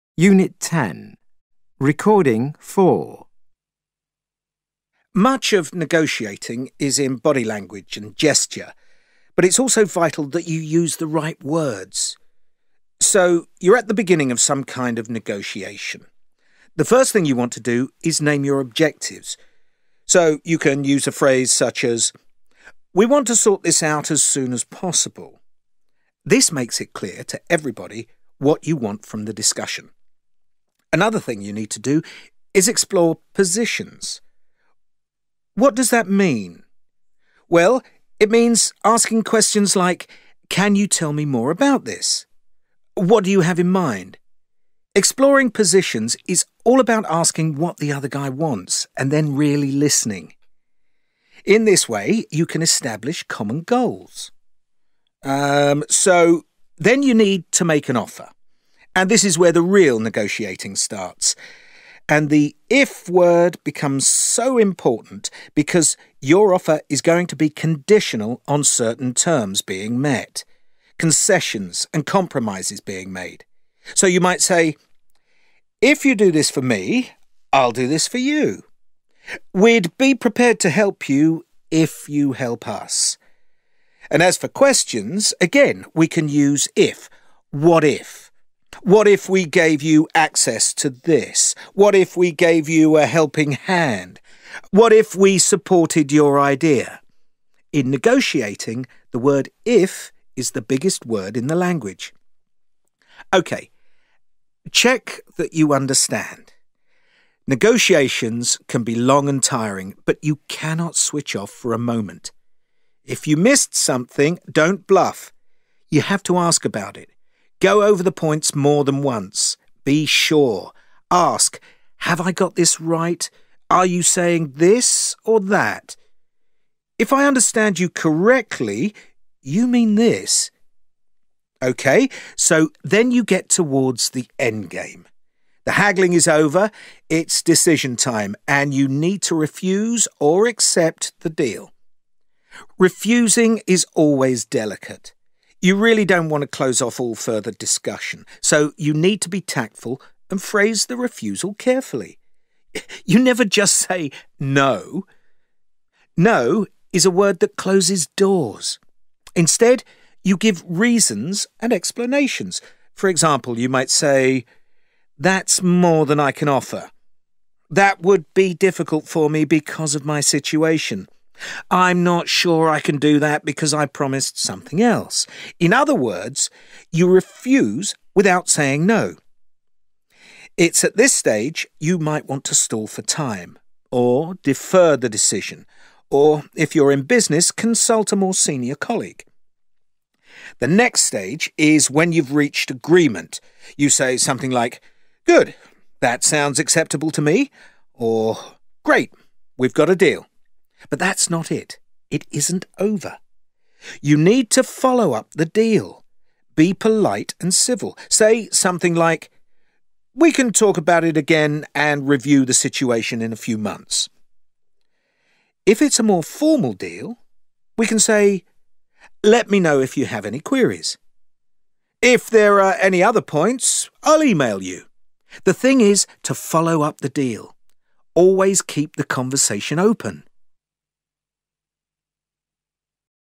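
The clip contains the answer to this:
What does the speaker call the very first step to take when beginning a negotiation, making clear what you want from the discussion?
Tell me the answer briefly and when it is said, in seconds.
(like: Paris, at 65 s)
name your objectives, at 18 s.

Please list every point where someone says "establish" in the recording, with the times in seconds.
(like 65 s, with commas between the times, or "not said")
52 s.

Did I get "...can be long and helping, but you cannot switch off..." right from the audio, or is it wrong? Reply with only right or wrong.
wrong.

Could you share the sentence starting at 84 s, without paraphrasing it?
And as for questions, again, we can use if.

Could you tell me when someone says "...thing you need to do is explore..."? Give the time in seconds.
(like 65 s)
31 s.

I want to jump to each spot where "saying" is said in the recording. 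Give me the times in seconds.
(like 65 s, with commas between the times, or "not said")
124 s, 178 s.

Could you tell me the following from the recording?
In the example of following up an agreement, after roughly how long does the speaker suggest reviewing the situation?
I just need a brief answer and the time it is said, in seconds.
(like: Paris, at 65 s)
a few months, at 213 s.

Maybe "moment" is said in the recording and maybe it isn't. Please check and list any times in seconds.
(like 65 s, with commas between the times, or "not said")
111 s.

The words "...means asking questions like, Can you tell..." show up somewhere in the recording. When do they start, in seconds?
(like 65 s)
38 s.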